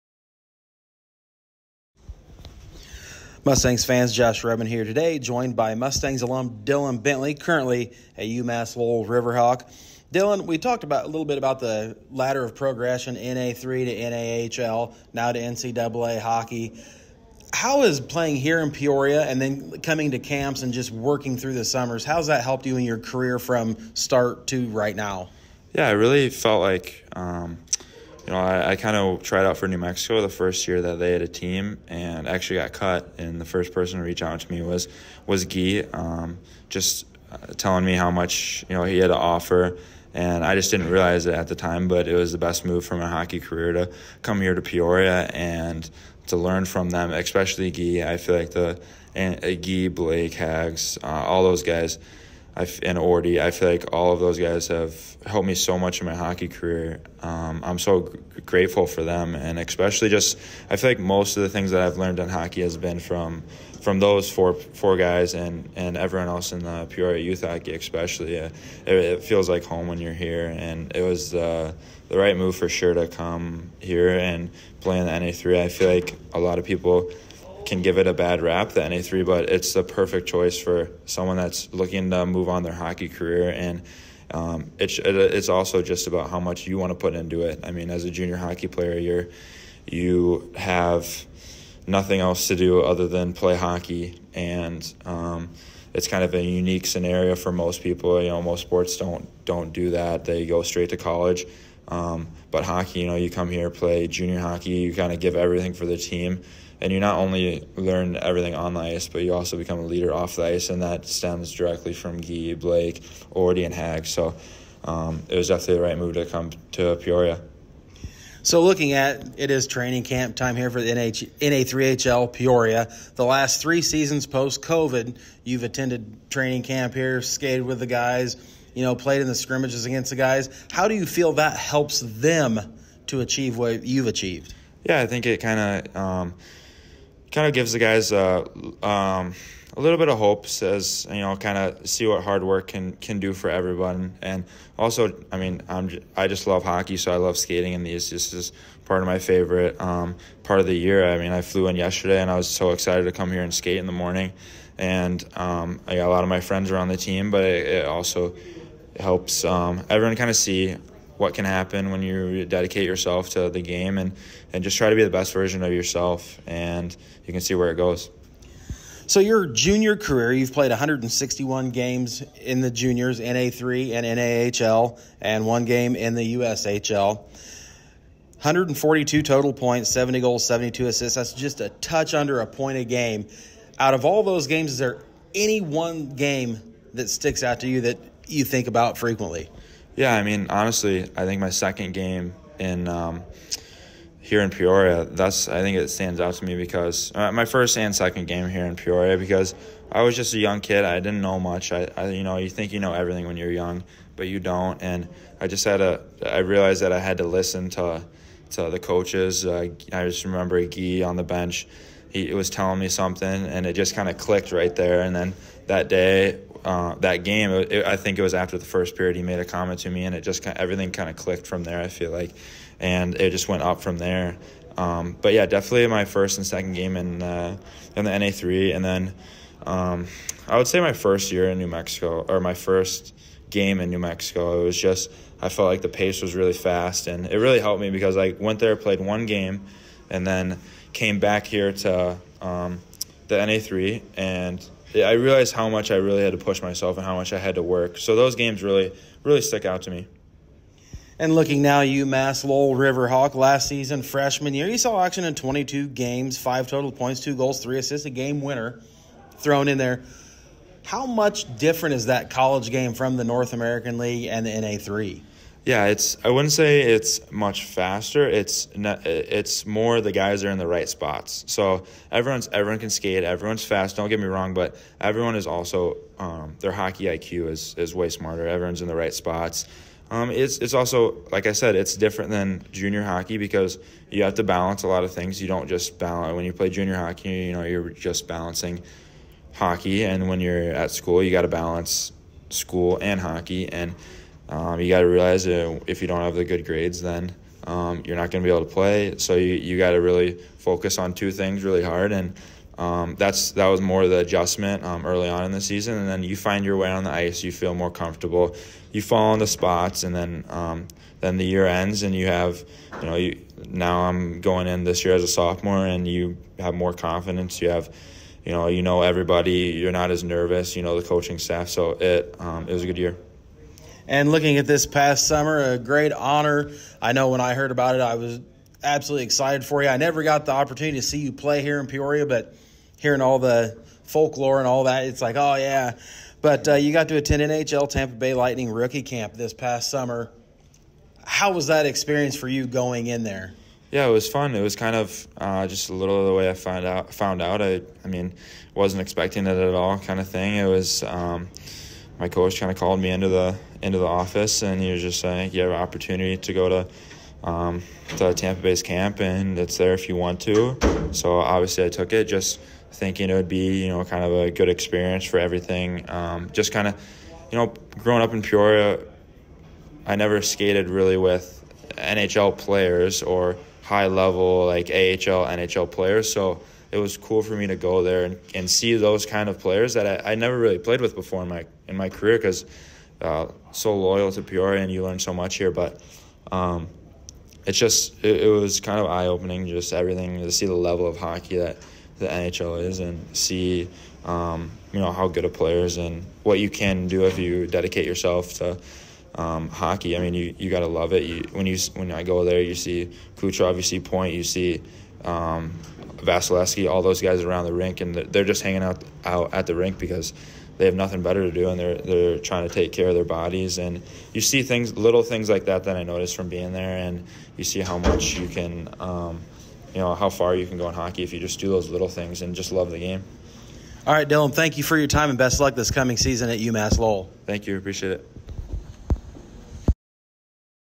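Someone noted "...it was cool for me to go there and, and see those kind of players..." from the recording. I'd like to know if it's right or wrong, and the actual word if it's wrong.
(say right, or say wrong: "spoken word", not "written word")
right.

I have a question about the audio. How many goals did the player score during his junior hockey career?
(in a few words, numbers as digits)
70.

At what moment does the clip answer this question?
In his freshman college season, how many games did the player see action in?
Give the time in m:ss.
4:15.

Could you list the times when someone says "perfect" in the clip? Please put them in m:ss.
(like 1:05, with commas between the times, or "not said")
1:19.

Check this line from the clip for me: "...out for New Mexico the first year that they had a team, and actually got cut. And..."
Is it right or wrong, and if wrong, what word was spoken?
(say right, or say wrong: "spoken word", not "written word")
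right.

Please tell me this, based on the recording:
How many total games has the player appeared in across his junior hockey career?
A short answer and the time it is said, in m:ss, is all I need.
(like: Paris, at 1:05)
161, at 2:50.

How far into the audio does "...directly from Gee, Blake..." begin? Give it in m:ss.
1:51.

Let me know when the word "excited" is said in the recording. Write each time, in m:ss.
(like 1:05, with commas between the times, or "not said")
2:32, 5:29.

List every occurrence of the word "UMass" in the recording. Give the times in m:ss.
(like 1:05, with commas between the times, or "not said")
0:08, 4:11, 7:06.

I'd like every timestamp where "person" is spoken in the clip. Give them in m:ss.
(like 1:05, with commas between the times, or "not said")
0:33.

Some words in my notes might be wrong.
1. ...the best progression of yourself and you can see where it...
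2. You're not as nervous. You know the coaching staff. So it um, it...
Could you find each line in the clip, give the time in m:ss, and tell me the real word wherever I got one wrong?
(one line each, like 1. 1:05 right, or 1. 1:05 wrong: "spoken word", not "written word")
1. 2:45 wrong: "version", not "progression"
2. 5:19 right.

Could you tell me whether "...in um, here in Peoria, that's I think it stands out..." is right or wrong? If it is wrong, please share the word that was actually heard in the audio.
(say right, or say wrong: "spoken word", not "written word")
right.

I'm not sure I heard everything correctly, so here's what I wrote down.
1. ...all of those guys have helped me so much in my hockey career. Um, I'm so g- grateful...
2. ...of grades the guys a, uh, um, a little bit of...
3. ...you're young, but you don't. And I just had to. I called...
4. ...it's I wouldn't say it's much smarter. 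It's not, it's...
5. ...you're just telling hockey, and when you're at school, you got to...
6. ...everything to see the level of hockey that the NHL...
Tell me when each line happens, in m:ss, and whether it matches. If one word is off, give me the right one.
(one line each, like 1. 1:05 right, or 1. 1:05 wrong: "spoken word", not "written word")
1. 0:53 right
2. 2:17 wrong: "gives", not "grades"
3. 3:23 wrong: "realized", not "called"
4. 4:25 wrong: "faster", not "smarter"
5. 4:47 wrong: "balancing", not "telling"
6. 6:29 right.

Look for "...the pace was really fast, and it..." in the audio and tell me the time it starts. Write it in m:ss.
3:55.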